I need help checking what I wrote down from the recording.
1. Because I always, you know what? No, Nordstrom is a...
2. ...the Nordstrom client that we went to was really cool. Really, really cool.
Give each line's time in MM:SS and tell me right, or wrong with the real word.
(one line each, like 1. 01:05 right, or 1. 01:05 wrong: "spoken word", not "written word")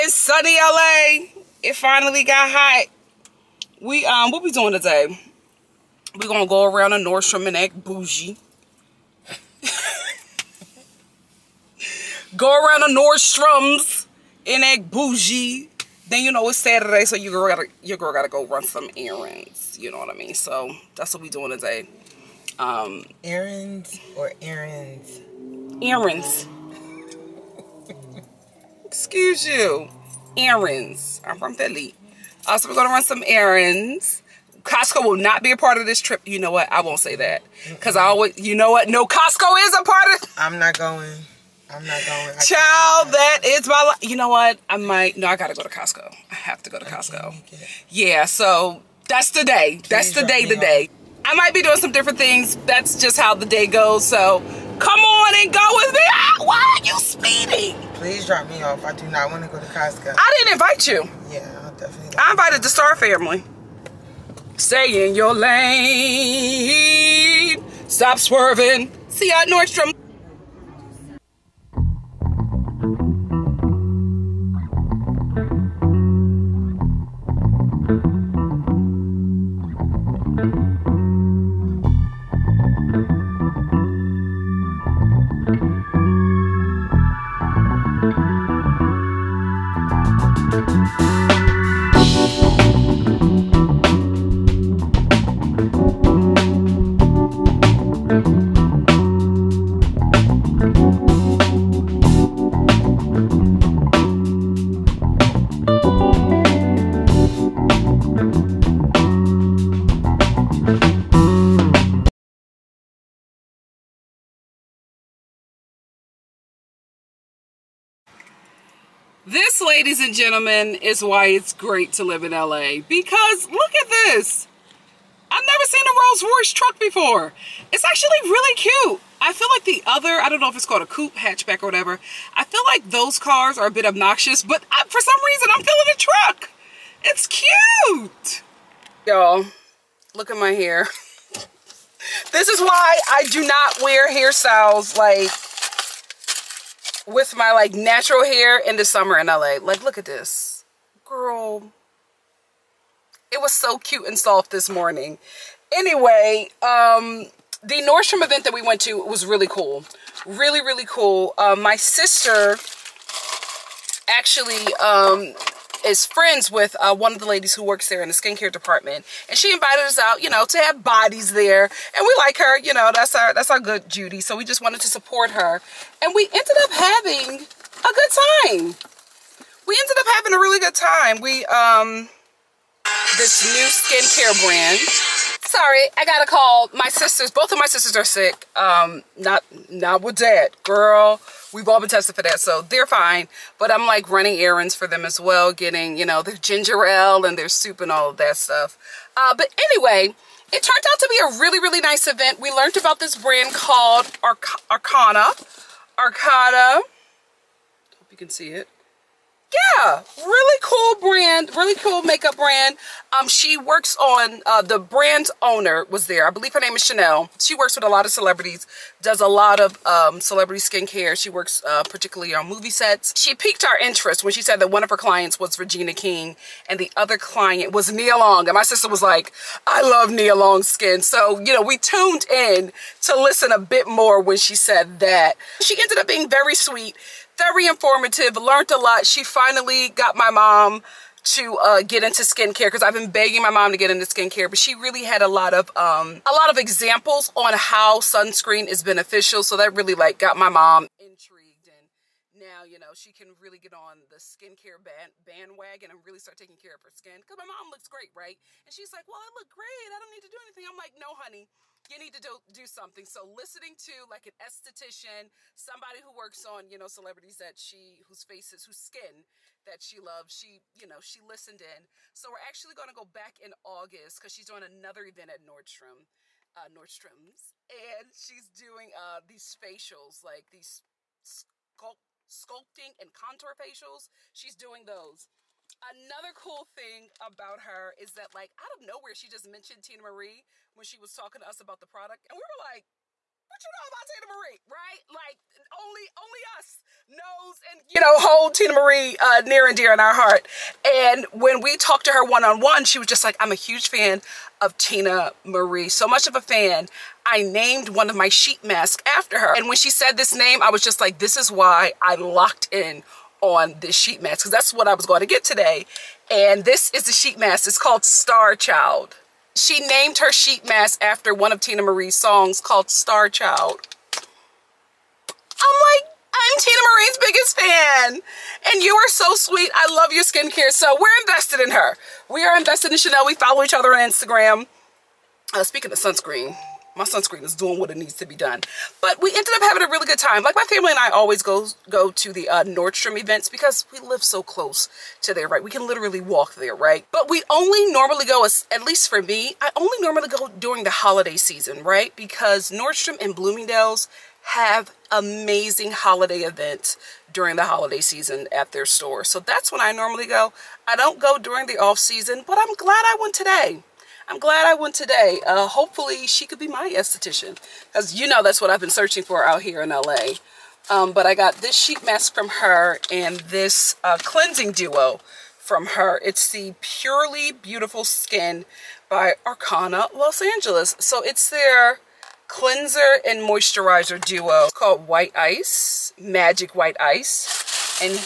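1. 00:37 wrong: "Costco", not "Nordstrom"
2. 02:37 wrong: "event", not "client".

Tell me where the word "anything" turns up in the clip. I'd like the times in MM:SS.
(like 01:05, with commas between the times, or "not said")
04:20.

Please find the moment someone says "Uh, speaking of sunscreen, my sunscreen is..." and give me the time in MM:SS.
05:35.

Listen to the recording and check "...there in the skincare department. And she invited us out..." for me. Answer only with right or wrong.
right.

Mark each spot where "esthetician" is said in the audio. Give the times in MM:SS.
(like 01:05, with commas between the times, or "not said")
04:24, 06:06.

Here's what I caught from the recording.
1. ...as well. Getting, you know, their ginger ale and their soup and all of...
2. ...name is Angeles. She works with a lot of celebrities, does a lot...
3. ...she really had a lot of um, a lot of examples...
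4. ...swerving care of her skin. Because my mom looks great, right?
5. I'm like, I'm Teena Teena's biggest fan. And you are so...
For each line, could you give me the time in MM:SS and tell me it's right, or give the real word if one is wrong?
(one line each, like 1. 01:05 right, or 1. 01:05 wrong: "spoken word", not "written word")
1. 03:15 right
2. 03:36 wrong: "Chanel", not "Angeles"
3. 04:04 right
4. 04:16 wrong: "taking", not "swerving"
5. 05:25 wrong: "Marie", not "Teena".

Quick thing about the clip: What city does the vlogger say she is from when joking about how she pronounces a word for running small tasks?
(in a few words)
Philly.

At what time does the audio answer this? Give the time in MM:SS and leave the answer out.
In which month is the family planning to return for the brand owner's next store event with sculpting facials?
04:33.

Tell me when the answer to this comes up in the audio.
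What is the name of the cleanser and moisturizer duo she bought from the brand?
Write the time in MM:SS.
06:26.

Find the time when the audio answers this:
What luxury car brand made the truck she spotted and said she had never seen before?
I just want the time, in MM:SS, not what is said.
02:05.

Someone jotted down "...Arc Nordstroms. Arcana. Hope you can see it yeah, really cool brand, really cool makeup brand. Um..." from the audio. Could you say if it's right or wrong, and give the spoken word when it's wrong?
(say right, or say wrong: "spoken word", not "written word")
wrong: "Arcana", not "Nordstroms".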